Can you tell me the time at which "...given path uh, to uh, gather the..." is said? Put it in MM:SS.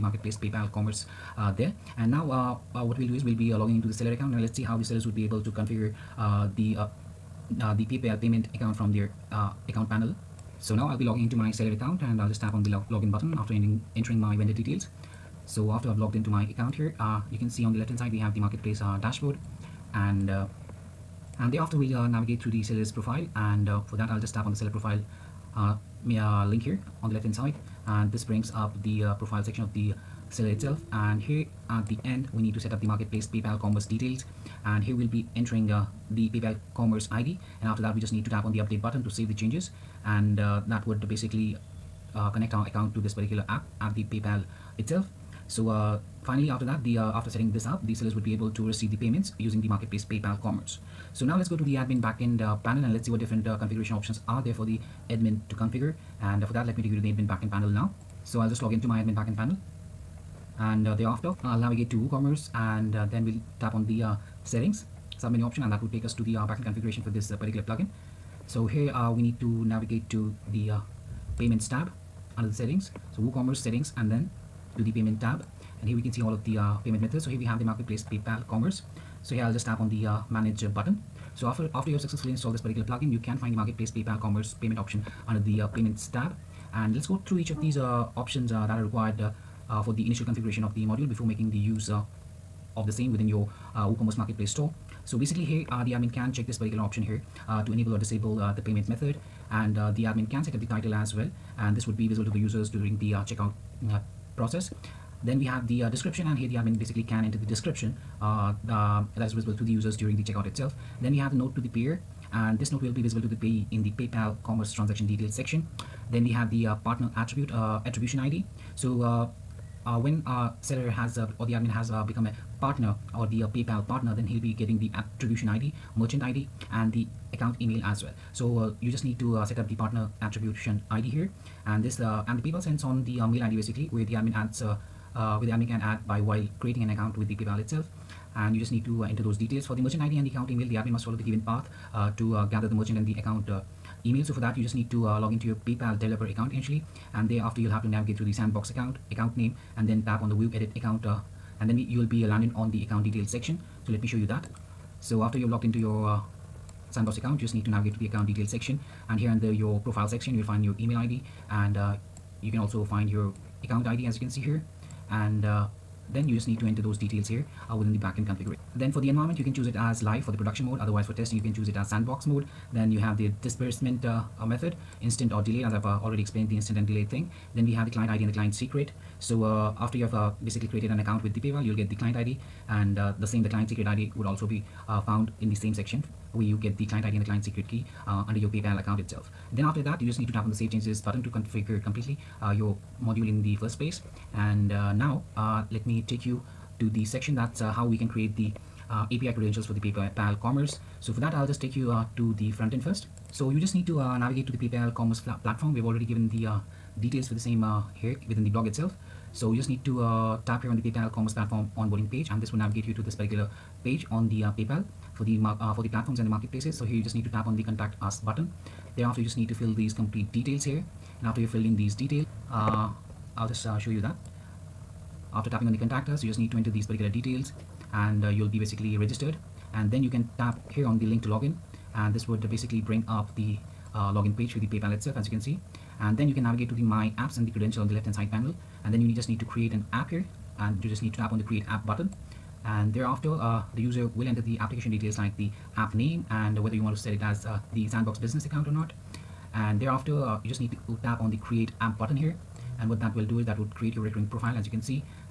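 02:21.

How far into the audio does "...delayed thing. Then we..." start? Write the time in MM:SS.
02:56.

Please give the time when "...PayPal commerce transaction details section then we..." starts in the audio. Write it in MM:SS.
01:53.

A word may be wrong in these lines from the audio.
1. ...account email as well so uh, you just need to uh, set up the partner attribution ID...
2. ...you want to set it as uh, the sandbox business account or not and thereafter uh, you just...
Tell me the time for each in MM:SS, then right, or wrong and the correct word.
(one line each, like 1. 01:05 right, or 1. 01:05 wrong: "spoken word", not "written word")
1. 02:07 right
2. 04:06 right.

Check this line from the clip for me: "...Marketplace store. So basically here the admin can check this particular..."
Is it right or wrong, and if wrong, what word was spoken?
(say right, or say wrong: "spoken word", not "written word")
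right.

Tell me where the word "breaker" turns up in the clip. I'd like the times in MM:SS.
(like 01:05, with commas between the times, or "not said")
not said.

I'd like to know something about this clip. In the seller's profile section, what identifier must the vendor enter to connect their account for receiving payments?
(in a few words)
PayPal commerce ID.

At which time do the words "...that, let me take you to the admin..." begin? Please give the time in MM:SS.
00:56.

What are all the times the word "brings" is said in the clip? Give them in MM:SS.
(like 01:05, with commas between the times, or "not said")
00:28, 03:52.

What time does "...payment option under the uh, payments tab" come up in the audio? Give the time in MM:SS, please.
01:24.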